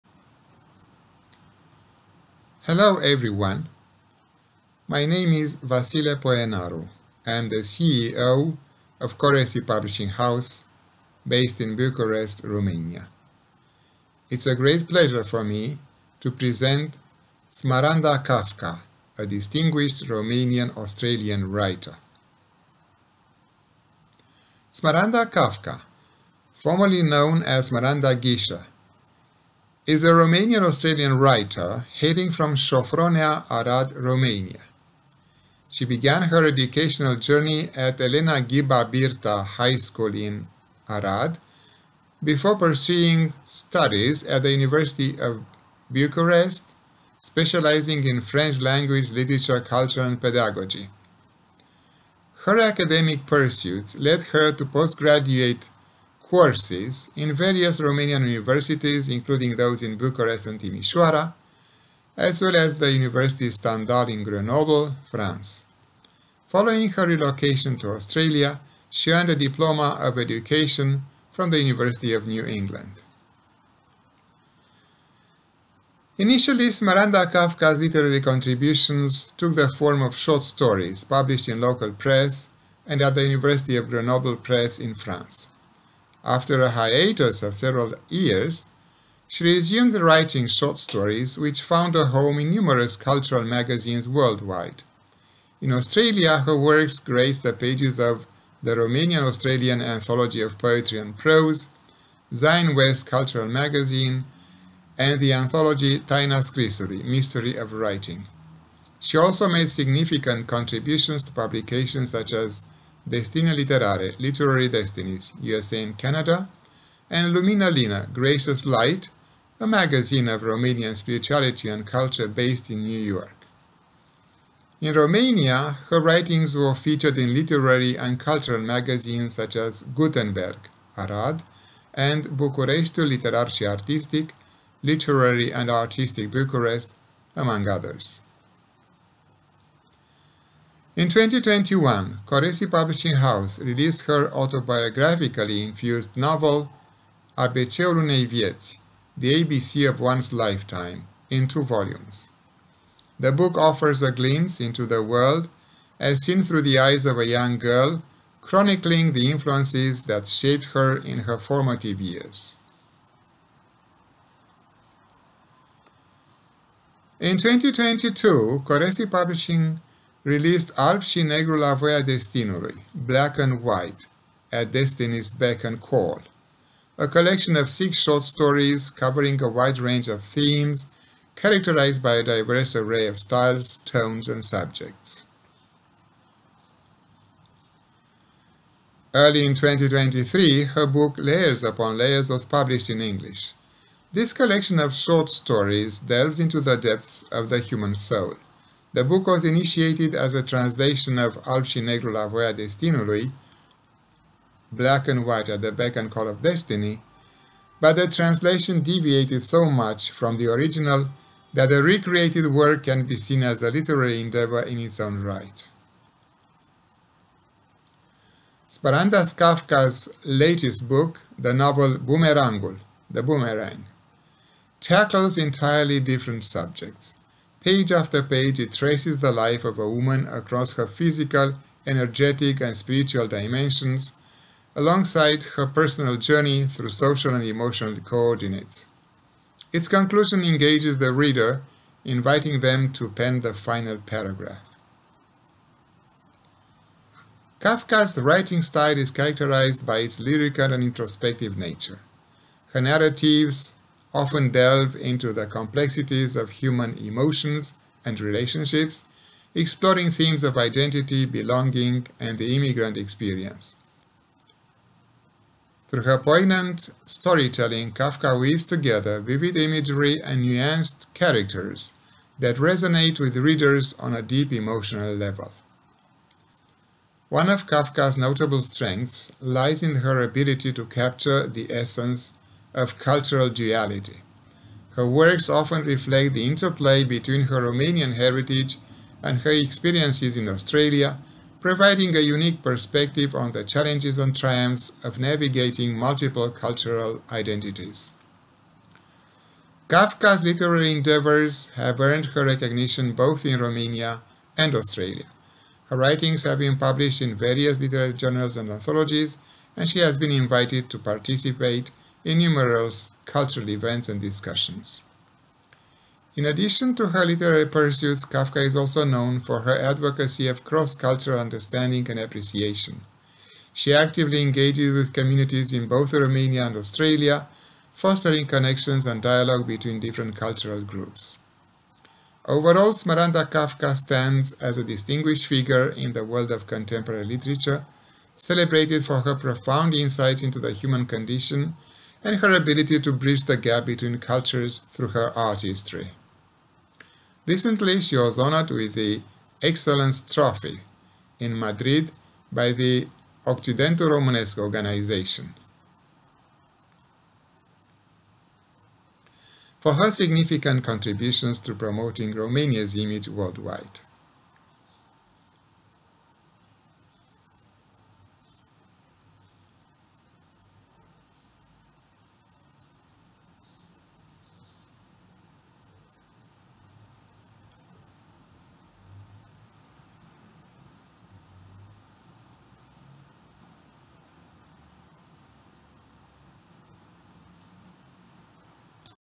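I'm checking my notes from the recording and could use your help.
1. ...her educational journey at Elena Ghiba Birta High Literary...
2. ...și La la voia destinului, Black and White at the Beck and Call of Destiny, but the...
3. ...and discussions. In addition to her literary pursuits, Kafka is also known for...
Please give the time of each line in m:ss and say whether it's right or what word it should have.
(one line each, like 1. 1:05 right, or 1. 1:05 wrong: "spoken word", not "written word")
1. 0:36 wrong: "School", not "Literary"
2. 3:21 right
3. 5:14 right.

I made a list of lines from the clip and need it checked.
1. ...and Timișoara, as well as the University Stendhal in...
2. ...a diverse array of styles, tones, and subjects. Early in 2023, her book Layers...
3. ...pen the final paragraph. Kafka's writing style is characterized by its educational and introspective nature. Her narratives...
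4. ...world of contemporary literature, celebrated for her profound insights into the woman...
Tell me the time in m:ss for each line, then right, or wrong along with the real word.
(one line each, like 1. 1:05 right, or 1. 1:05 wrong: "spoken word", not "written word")
1. 1:00 right
2. 3:02 right
3. 4:03 wrong: "lyrical", not "educational"
4. 5:36 wrong: "human", not "woman".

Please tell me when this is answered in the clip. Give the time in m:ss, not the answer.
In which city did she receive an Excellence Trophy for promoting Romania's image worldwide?
5:51.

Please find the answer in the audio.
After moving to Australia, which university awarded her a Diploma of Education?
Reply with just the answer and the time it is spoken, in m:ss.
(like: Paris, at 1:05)
University of New England, at 1:11.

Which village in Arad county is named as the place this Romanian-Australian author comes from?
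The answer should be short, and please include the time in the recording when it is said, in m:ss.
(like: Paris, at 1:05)
Șofronea, at 0:32.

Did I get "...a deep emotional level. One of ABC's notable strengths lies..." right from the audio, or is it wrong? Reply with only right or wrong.
wrong.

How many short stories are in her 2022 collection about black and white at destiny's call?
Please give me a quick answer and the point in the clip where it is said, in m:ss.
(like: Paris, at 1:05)
6, at 2:57.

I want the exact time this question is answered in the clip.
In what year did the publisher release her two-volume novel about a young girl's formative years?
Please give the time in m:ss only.
2:21.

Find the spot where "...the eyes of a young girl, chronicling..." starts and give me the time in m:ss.
2:36.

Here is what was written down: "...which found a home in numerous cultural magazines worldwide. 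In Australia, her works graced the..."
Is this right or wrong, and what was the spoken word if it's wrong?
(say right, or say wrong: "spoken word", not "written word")
right.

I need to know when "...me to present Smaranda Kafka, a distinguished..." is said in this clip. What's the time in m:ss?
0:15.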